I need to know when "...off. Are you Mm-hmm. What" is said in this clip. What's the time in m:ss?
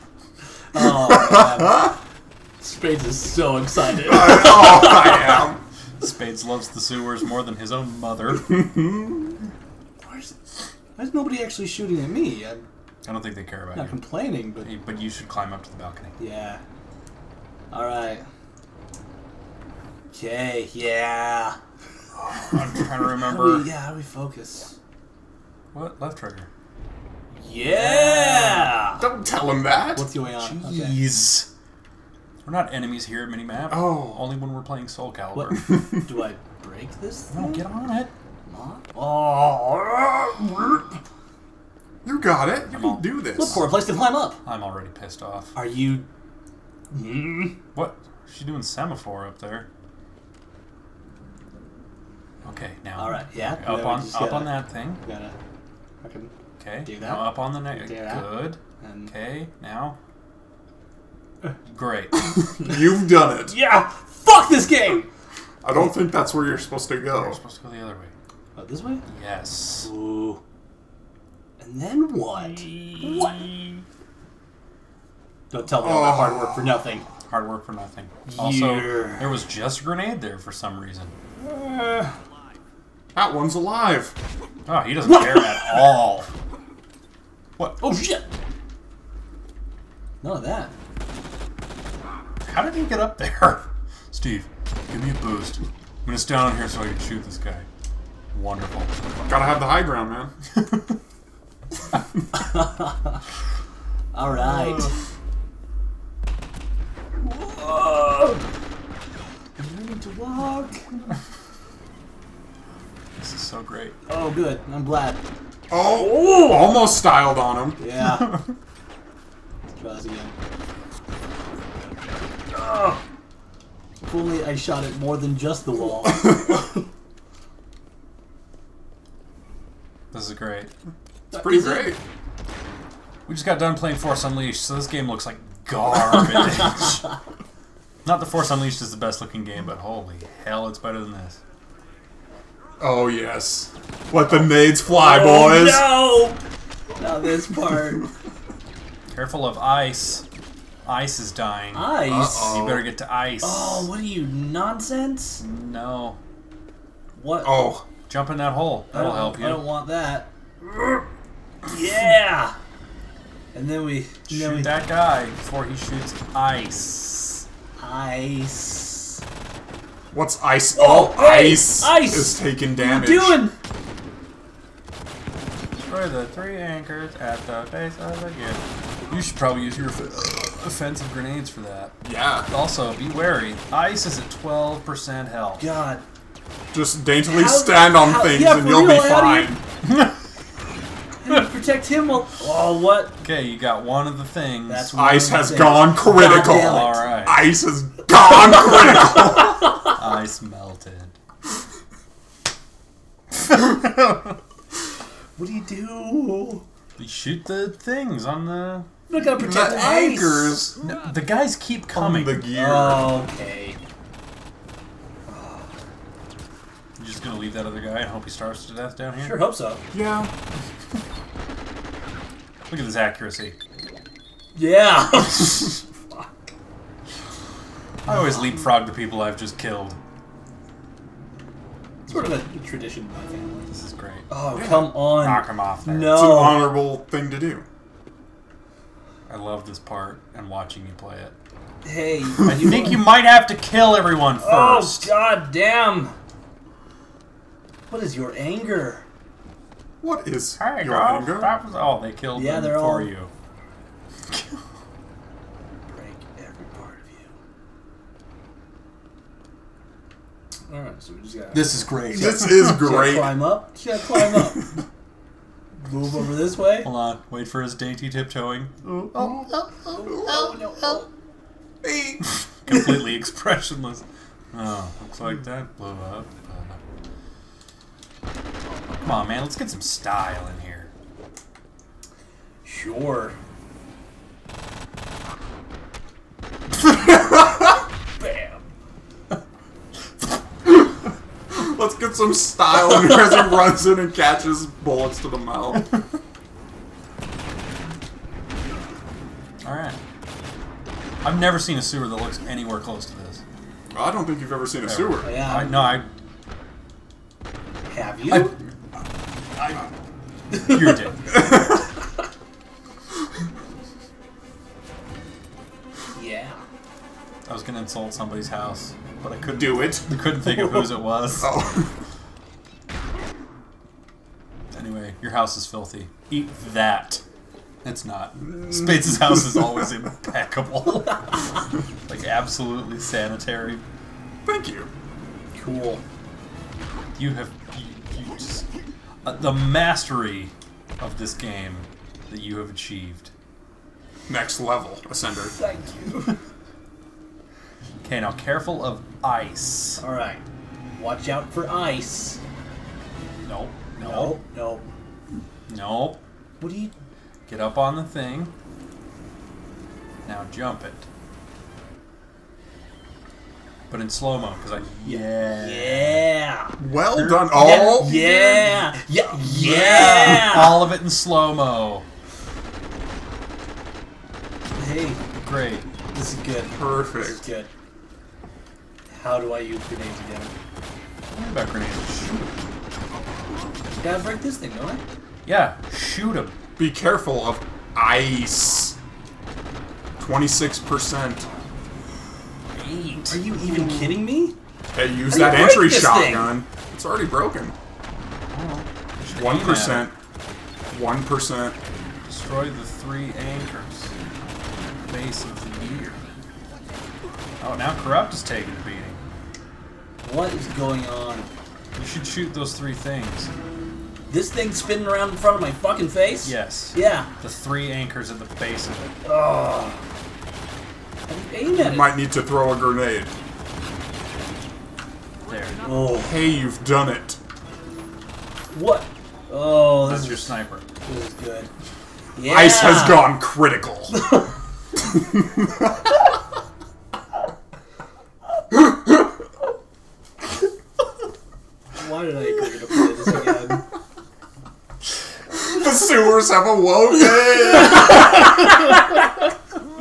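0:45.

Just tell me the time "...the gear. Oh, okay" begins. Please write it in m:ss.
3:32.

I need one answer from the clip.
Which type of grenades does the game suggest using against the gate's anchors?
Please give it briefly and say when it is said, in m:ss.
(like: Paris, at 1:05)
offensive grenades, at 2:59.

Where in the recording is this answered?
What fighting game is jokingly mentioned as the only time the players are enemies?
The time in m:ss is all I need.
0:34.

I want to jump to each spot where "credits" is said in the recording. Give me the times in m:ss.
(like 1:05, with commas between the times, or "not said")
not said.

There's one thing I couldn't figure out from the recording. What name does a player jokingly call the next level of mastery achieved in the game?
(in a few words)
Ascender.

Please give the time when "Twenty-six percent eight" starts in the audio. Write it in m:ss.
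6:30.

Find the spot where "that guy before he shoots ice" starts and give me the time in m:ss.
2:44.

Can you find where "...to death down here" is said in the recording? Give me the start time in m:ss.
3:38.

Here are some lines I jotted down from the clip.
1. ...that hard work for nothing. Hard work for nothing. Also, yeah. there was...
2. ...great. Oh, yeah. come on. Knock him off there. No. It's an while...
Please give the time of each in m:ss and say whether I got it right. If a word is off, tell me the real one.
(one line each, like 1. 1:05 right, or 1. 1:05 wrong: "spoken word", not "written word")
1. 1:16 right
2. 3:53 wrong: "honorable", not "while".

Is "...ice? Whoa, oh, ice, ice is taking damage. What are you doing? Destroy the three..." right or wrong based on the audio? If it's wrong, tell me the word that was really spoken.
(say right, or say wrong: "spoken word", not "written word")
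right.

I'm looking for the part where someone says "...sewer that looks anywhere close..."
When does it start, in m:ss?
5:01.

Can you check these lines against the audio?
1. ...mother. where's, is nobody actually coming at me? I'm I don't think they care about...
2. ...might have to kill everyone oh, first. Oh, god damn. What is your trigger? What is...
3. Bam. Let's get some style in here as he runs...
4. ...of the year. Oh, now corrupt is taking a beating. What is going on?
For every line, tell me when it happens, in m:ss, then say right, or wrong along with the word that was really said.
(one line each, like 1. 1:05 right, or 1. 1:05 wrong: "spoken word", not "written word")
1. 0:07 wrong: "shooting", not "coming"
2. 4:02 wrong: "anger", not "trigger"
3. 4:48 right
4. 6:45 right.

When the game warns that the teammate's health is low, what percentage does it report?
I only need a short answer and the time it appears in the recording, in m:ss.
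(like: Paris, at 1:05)
12%, at 3:04.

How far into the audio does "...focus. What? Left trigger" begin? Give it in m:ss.
0:24.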